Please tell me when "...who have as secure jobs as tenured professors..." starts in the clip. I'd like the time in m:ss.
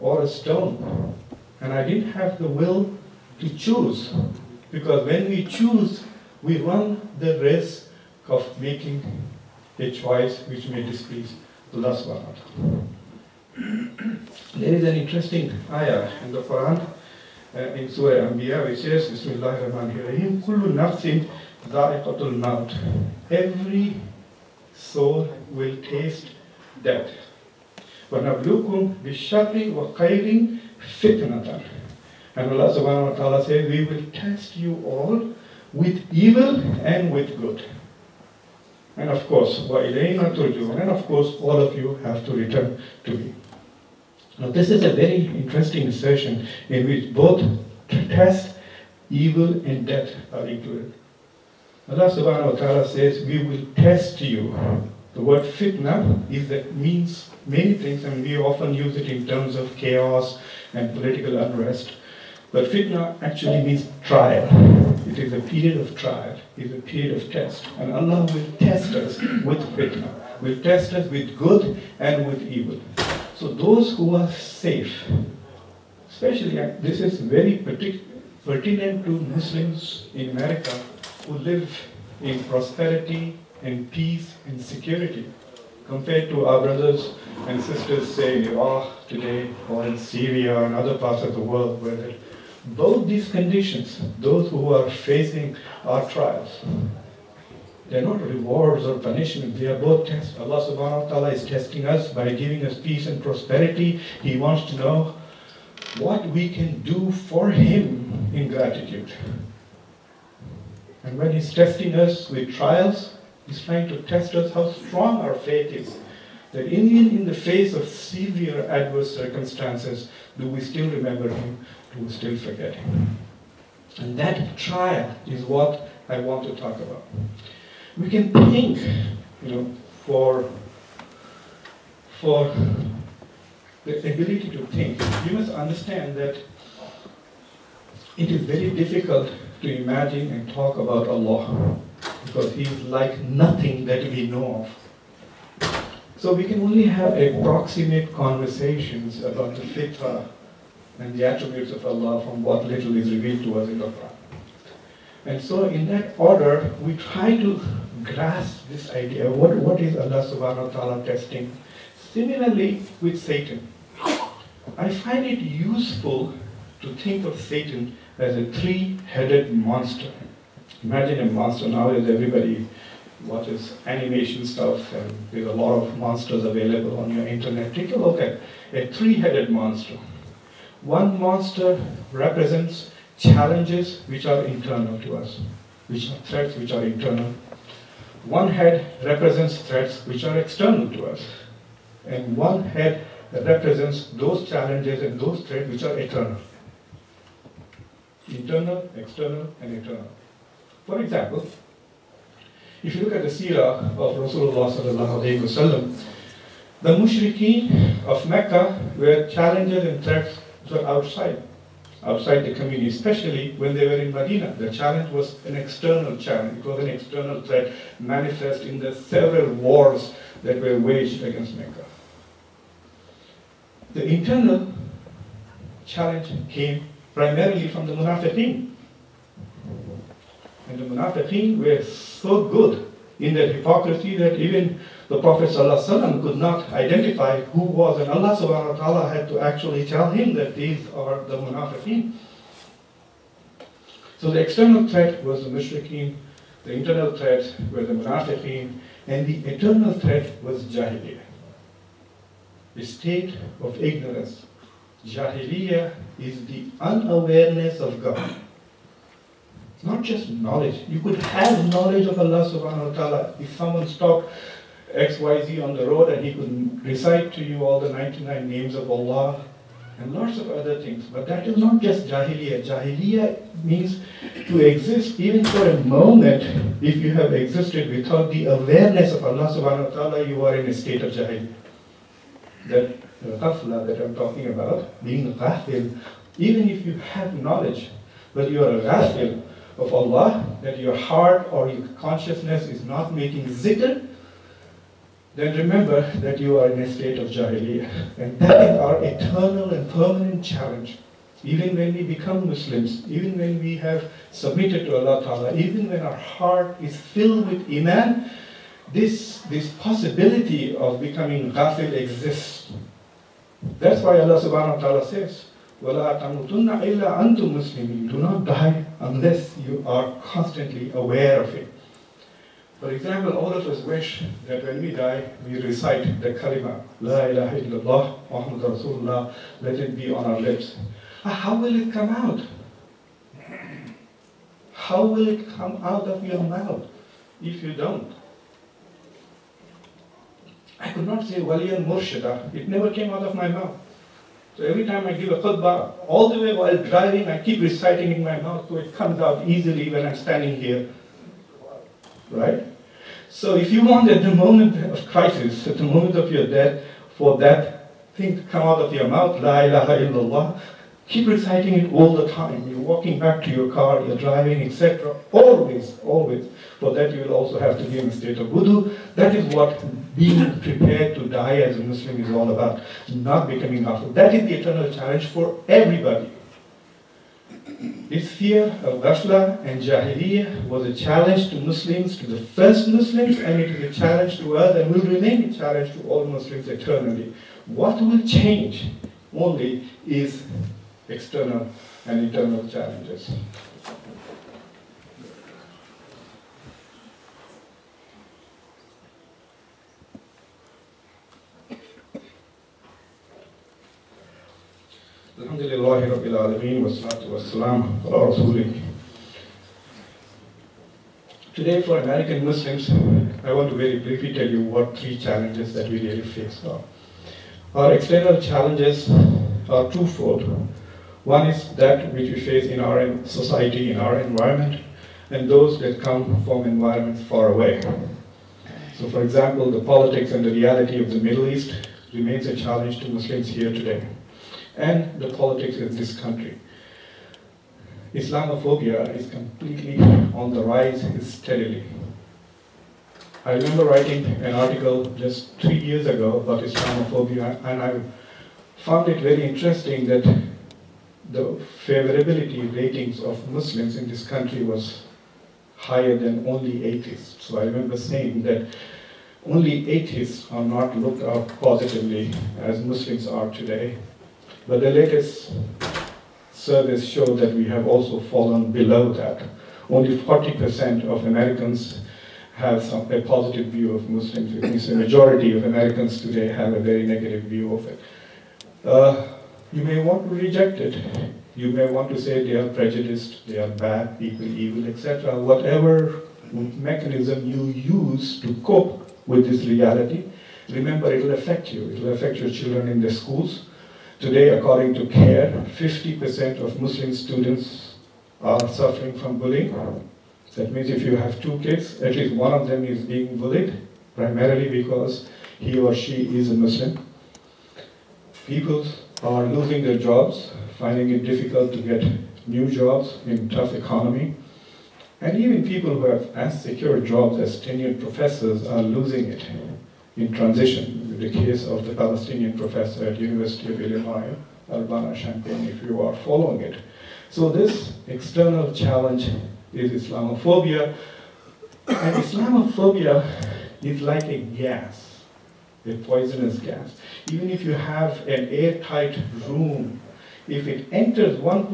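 8:35.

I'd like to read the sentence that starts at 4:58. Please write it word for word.
And that is our eternal and permanent challenge.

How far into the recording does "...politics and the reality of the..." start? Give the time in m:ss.
7:09.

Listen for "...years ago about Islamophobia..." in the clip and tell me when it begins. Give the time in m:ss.
7:25.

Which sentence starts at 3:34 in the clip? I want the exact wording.
The challenge was an external challenge.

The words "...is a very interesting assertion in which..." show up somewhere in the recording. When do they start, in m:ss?
0:44.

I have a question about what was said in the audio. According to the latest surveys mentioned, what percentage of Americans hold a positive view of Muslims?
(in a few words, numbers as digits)
40%.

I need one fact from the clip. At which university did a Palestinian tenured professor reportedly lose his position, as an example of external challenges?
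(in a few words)
University of Illinois, Urbana Champaign.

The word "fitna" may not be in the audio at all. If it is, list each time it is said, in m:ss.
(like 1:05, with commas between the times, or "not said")
0:55, 1:02, 1:09.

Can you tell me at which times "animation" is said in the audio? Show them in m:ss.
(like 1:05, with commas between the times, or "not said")
2:53.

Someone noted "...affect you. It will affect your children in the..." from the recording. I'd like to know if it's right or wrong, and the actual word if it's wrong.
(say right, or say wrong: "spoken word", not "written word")
right.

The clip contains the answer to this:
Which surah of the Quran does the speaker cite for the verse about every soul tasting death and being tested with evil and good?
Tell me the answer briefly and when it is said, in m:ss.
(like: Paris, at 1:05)
Surah Anbiya, at 0:17.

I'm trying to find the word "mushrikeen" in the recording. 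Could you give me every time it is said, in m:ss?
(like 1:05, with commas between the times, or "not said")
3:26, 4:05.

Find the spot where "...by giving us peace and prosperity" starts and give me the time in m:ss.
1:42.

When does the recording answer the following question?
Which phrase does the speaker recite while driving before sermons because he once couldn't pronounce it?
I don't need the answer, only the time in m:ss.
5:41.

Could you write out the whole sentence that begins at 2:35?
And so in that order, we try to grasp this idea, what, what is Allah subhanahu wa ta'ala testing?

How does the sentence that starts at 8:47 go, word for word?
So this external challenge is Islamophobia.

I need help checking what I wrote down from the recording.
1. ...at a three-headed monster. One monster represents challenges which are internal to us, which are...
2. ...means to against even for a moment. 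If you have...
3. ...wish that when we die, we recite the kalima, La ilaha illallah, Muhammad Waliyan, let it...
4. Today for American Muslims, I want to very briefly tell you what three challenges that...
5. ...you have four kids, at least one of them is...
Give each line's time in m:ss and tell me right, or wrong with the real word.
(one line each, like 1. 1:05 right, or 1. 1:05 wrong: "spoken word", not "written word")
1. 2:58 right
2. 4:33 wrong: "exist", not "against"
3. 5:23 wrong: "Rasulullah", not "Waliyan"
4. 6:51 right
5. 8:21 wrong: "two", not "four".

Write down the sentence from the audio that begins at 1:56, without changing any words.
That even in the face of severe adverse circumstances, do we still remember him?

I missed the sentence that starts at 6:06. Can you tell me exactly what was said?
For that you will also have to be in a state of wudu.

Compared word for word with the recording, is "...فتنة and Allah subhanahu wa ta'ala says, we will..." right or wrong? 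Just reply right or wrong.
right.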